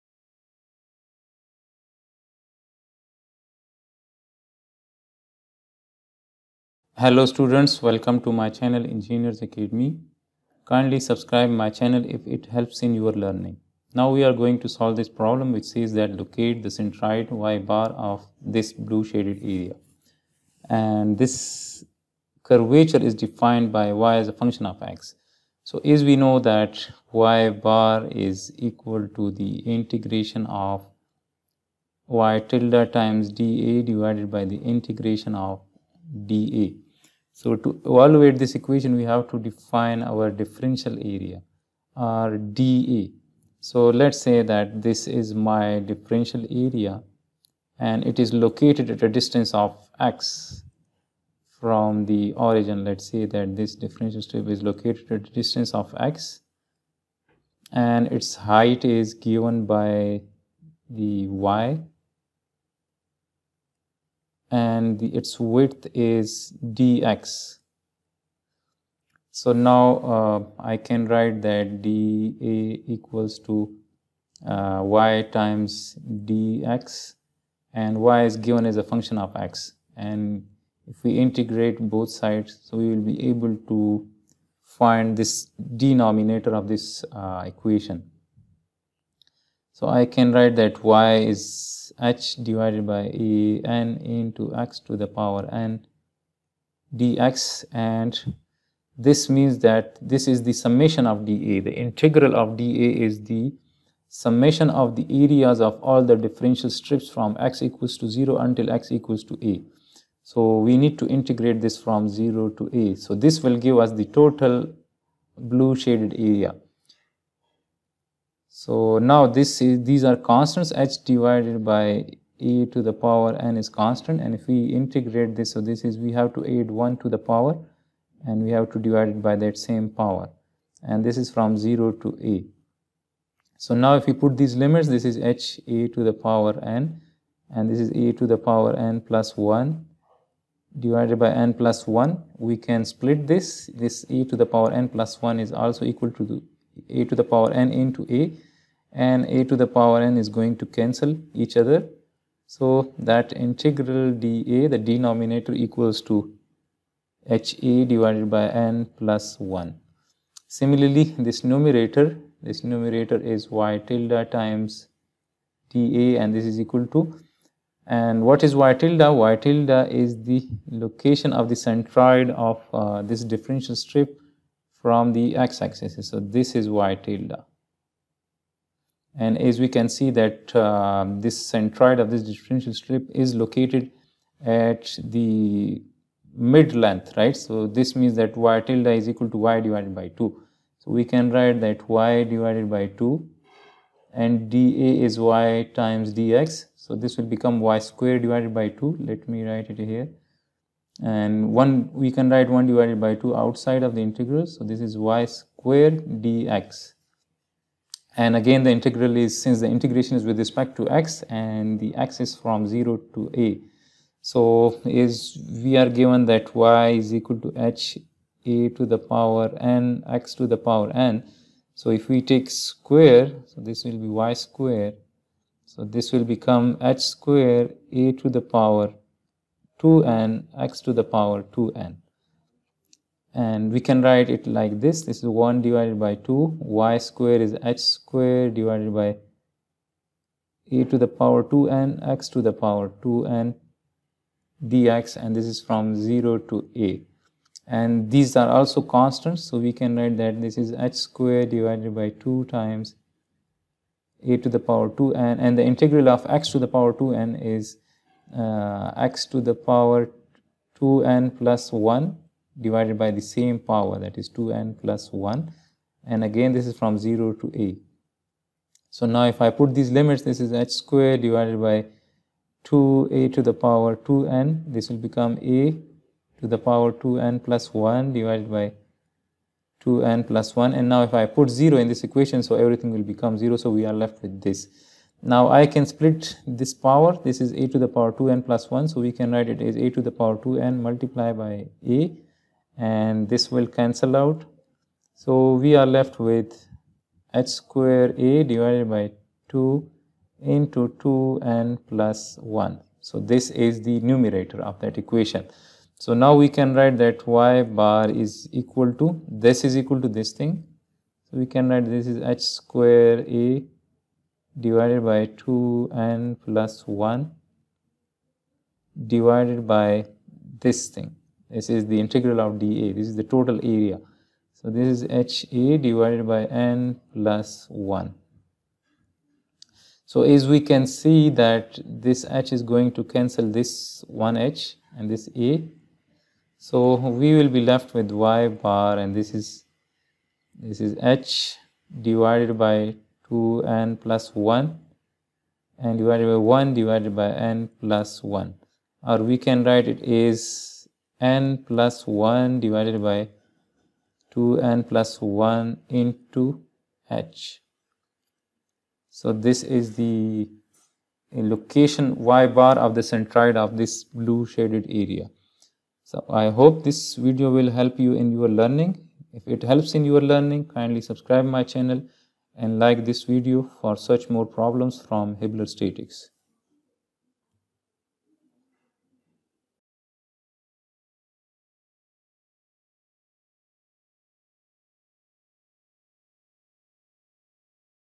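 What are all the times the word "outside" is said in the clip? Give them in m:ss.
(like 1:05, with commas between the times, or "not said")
3:23.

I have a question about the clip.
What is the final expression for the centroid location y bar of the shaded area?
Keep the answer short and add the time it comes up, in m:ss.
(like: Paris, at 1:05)
(n+1)h/(2n+1), at 5:51.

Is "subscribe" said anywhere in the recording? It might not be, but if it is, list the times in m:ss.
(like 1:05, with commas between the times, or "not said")
0:10, 6:11.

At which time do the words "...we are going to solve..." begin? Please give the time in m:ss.
0:14.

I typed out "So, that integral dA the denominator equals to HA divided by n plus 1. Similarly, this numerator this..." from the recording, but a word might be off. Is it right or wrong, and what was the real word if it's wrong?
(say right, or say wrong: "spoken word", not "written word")
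right.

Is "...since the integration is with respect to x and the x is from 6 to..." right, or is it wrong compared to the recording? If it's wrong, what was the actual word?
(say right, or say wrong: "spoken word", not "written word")
wrong: "0", not "6".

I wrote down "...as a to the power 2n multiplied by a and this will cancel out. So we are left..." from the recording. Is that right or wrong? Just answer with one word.
right.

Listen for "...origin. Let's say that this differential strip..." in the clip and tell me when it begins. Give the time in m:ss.
0:52.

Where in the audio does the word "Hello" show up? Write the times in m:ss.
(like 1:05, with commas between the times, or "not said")
0:06.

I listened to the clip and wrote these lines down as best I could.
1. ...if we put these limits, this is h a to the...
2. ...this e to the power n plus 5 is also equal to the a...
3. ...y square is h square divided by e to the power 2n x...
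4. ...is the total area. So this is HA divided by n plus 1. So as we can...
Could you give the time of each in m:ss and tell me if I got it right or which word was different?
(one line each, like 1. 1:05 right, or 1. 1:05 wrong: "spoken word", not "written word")
1. 2:13 right
2. 2:23 wrong: "1", not "5"
3. 3:56 right
4. 5:23 right.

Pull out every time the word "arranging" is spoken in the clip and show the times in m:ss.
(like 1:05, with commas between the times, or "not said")
not said.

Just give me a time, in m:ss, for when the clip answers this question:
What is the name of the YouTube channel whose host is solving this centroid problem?
0:08.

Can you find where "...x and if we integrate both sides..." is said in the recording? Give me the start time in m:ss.
1:19.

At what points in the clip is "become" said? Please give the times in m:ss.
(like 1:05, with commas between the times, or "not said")
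3:17, 3:46, 4:35, 4:43.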